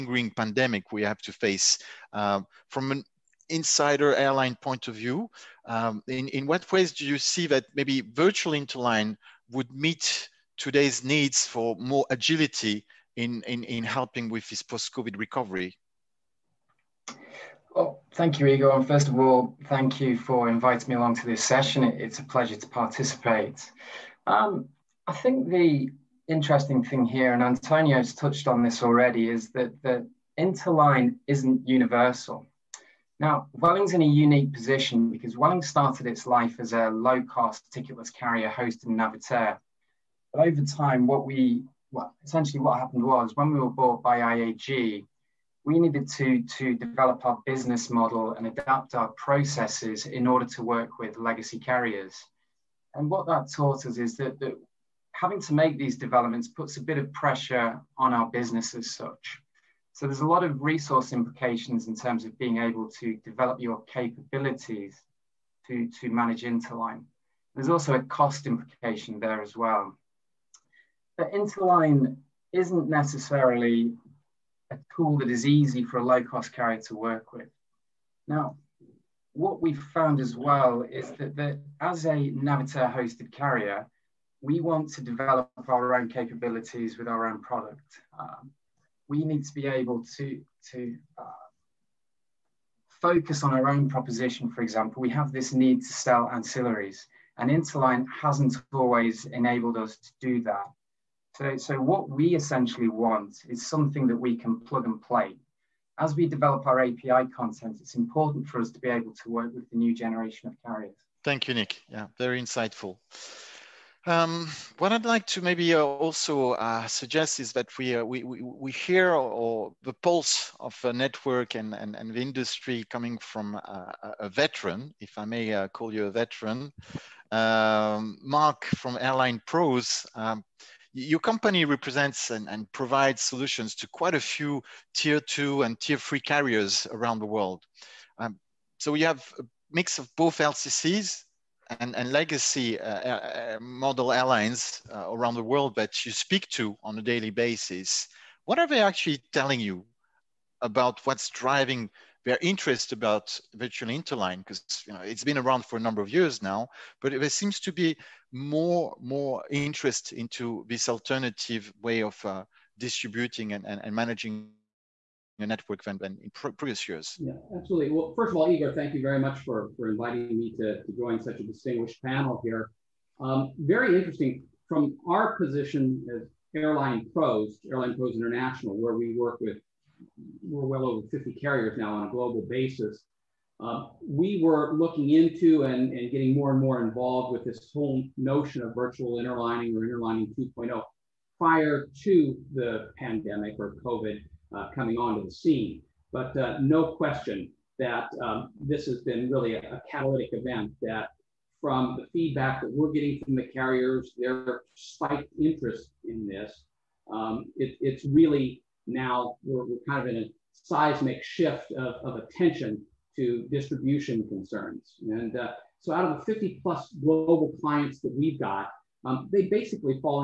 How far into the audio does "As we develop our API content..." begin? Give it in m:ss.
1:45.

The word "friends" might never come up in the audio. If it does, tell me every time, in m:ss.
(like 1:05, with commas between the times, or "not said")
not said.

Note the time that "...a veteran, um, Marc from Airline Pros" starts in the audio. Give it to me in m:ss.
2:06.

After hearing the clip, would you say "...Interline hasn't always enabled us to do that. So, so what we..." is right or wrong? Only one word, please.
right.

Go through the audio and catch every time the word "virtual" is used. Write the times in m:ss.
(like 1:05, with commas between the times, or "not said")
0:08, 2:33, 3:08.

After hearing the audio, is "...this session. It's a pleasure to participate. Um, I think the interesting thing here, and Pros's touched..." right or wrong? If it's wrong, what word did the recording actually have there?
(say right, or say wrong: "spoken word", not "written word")
wrong: "Antonio", not "Pros".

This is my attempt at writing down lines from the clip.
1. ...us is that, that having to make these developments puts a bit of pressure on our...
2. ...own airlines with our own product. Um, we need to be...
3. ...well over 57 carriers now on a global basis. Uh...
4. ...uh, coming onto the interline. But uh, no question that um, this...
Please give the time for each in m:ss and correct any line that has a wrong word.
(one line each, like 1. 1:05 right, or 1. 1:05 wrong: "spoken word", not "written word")
1. 0:53 right
2. 1:25 wrong: "capabilities", not "airlines"
3. 3:00 wrong: "50", not "57"
4. 3:14 wrong: "scene", not "interline".